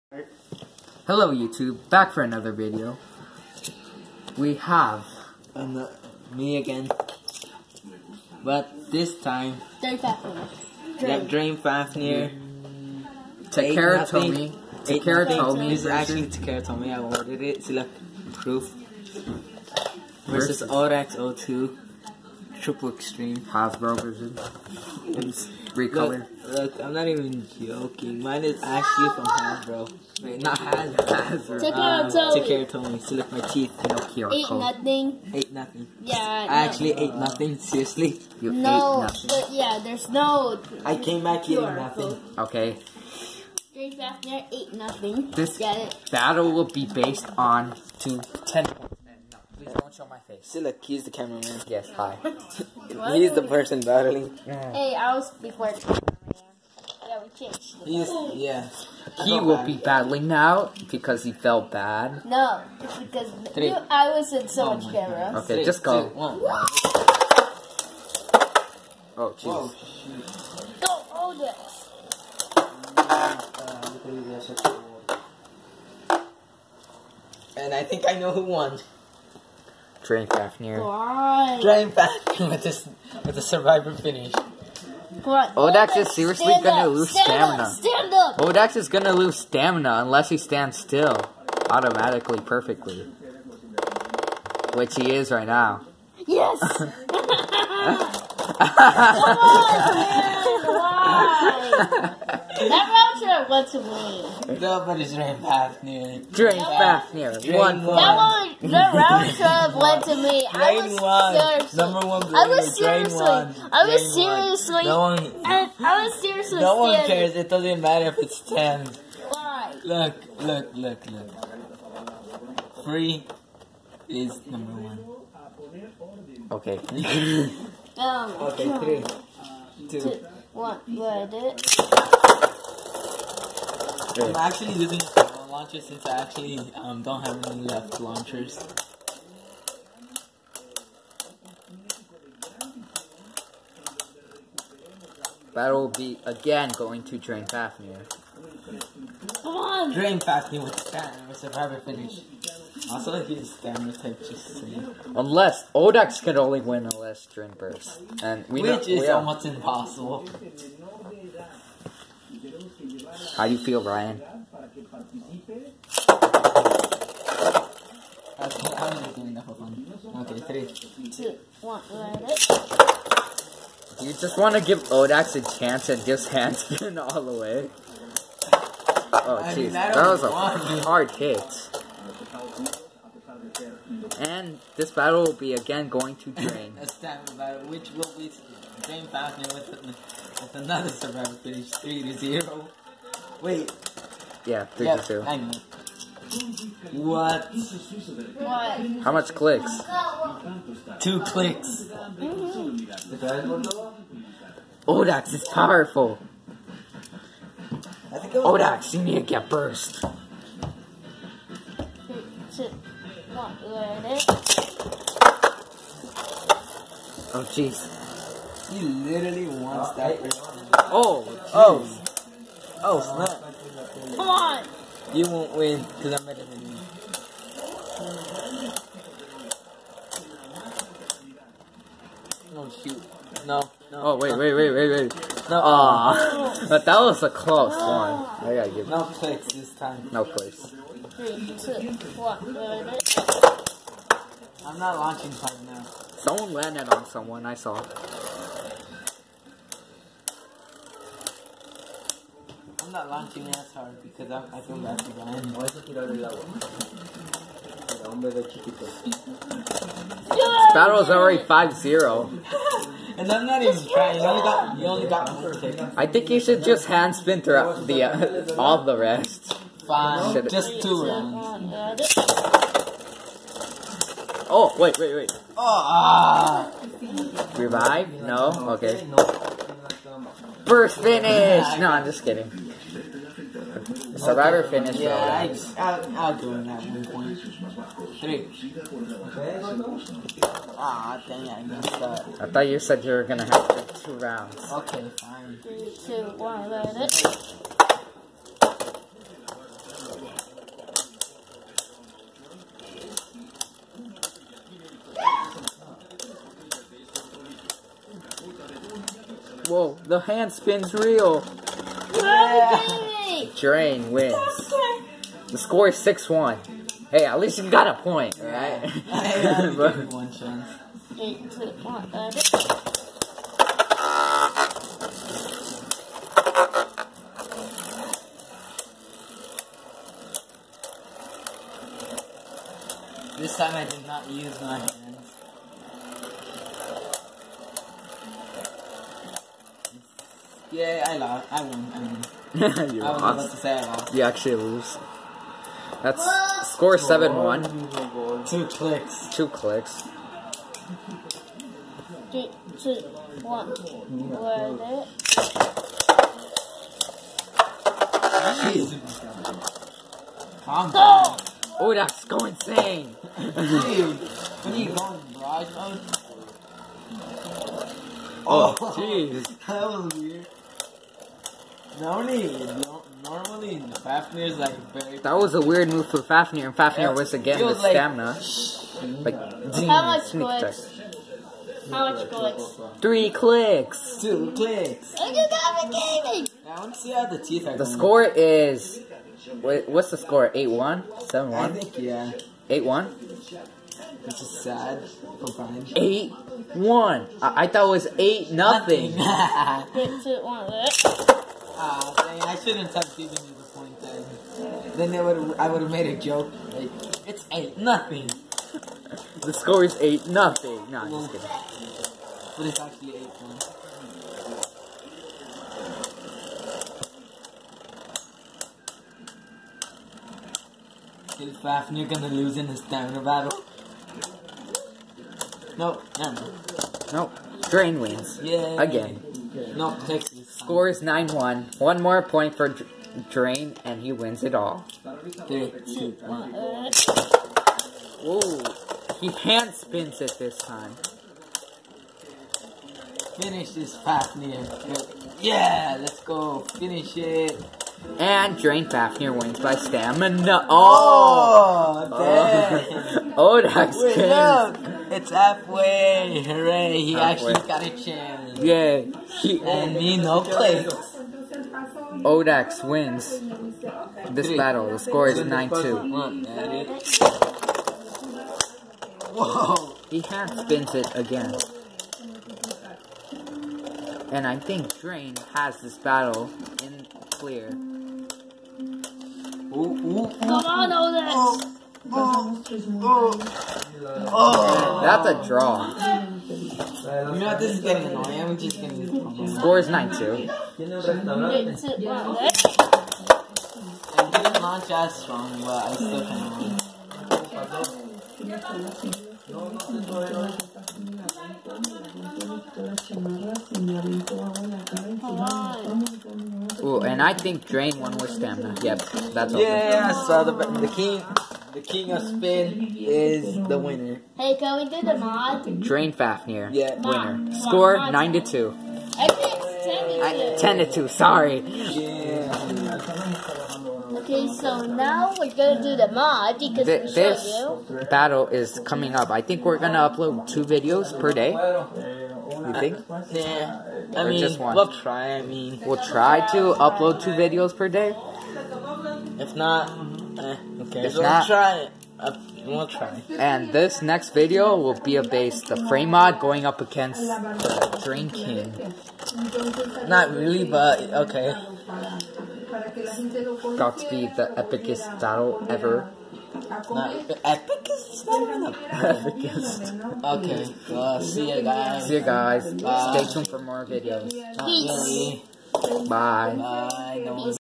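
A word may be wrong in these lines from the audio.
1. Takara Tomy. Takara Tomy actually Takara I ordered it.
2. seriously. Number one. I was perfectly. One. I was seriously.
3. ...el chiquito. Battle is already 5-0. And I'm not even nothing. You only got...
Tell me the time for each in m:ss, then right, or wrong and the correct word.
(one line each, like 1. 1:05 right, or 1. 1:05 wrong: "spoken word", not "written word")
1. 0:13 right
2. 1:51 wrong: "seriously", not "perfectly"
3. 4:18 wrong: "trying", not "nothing".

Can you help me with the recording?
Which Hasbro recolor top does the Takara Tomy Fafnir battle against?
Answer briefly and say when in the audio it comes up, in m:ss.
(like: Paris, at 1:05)
Odax 02 Triple Extreme, at 0:20.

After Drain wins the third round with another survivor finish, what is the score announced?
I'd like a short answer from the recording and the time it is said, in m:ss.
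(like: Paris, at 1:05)
3 to 0, at 3:11.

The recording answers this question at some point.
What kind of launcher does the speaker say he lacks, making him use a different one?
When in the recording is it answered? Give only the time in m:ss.
2:17.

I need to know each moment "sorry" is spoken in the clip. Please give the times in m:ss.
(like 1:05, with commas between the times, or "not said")
8:41.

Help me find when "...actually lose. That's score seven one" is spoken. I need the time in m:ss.
5:44.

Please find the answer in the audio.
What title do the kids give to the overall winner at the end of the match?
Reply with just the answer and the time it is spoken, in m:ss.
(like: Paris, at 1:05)
The king of spin, at 8:31.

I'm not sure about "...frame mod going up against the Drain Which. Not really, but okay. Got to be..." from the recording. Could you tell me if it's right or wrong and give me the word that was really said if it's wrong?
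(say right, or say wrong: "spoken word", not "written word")
wrong: "King", not "Which".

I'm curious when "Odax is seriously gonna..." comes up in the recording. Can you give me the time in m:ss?
1:25.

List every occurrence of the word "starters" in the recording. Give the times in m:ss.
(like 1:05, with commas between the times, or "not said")
not said.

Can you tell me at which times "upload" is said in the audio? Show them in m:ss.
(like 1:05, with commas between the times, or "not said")
8:50, 8:56.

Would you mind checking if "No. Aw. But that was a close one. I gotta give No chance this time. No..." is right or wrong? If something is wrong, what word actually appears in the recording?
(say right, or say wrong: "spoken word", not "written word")
wrong: "place", not "chance".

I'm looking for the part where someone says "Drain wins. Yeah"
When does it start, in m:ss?
7:07.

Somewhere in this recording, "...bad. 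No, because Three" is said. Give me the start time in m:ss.
1:01.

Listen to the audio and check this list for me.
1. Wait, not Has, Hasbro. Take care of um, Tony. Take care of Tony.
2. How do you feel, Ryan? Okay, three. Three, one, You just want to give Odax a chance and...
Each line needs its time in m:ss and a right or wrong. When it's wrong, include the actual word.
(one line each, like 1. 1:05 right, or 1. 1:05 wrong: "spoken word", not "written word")
1. 0:30 right
2. 2:43 wrong: "Two", not "Three".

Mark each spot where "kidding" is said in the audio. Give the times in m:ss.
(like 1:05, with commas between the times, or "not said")
4:42, 6:51.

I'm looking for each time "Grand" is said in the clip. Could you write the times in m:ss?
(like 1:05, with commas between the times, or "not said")
1:21.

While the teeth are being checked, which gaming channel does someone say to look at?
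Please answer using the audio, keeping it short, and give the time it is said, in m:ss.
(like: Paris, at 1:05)
Gavin Gaming, at 6:25.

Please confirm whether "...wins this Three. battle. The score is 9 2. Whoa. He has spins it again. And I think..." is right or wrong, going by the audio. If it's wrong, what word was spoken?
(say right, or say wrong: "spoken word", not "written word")
right.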